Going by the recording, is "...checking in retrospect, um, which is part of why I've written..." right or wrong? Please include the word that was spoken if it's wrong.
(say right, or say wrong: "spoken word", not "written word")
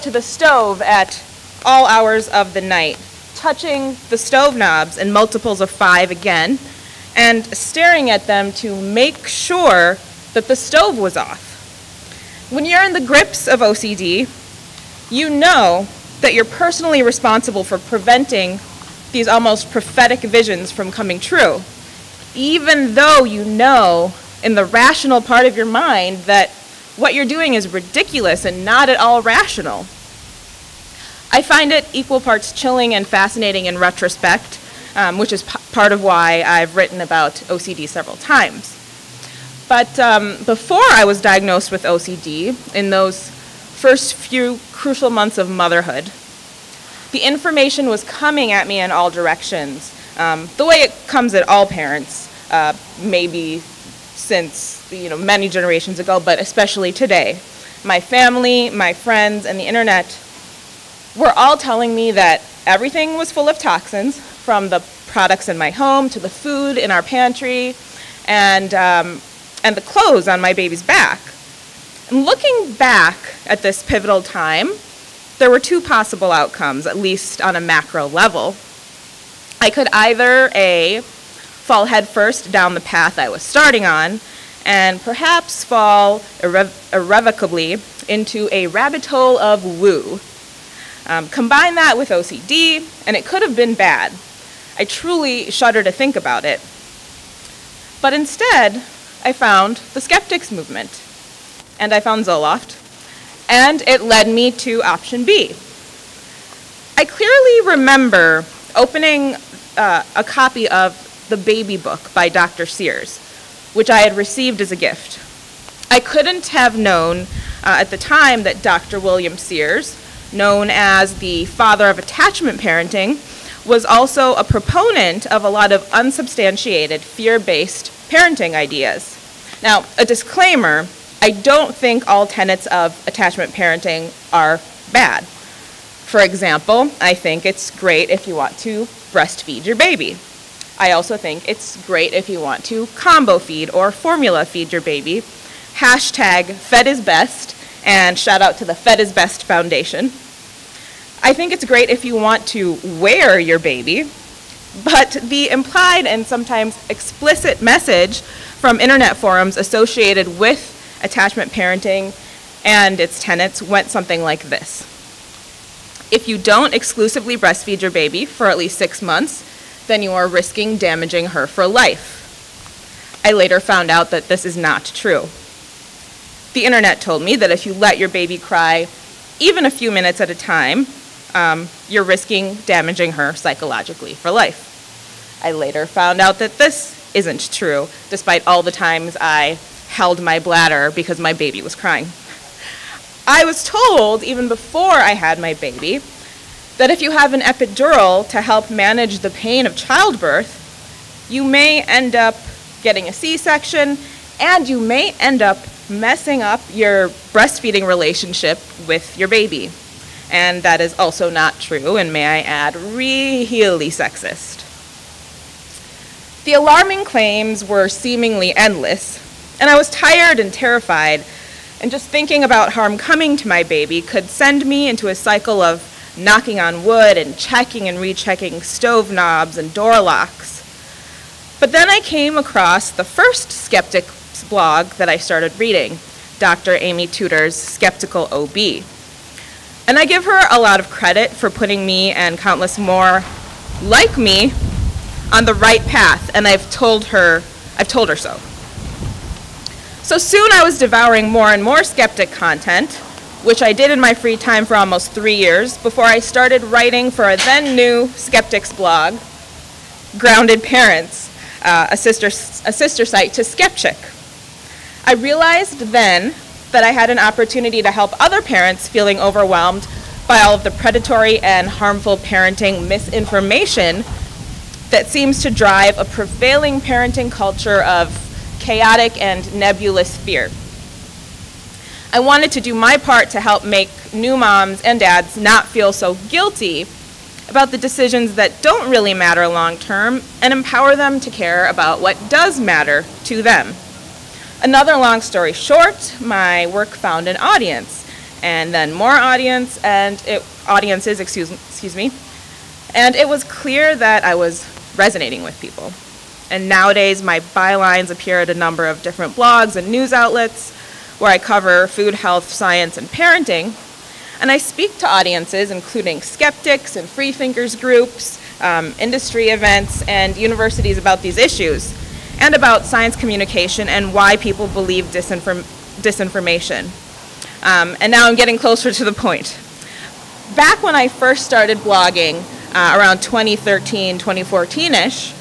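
wrong: "fascinating", not "checking".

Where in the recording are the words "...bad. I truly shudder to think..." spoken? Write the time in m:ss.
1:33.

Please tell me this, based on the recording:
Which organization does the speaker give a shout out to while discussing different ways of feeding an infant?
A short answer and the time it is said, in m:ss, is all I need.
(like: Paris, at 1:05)
Fed is Best Foundation, at 2:28.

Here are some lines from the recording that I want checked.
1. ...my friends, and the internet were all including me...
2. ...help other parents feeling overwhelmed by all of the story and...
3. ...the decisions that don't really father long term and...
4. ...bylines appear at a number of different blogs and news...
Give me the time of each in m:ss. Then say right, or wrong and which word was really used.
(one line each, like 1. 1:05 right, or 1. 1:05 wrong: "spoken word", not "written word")
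1. 0:58 wrong: "telling", not "including"
2. 4:27 wrong: "predatory", not "story"
3. 4:47 wrong: "matter", not "father"
4. 5:07 right.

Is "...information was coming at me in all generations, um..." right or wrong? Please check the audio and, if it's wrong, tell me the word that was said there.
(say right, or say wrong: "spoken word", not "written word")
wrong: "directions", not "generations".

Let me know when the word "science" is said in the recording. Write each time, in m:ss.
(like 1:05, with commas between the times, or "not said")
5:12, 5:22.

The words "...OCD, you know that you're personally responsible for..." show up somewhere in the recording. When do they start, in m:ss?
0:13.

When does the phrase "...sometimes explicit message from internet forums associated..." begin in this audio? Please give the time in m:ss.
2:36.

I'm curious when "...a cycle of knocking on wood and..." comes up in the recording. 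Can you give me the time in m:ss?
3:45.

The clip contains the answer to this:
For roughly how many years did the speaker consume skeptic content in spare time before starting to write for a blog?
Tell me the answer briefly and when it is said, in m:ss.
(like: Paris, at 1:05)
3 years, at 4:15.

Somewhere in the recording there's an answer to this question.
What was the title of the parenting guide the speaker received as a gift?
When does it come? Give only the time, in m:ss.
1:51.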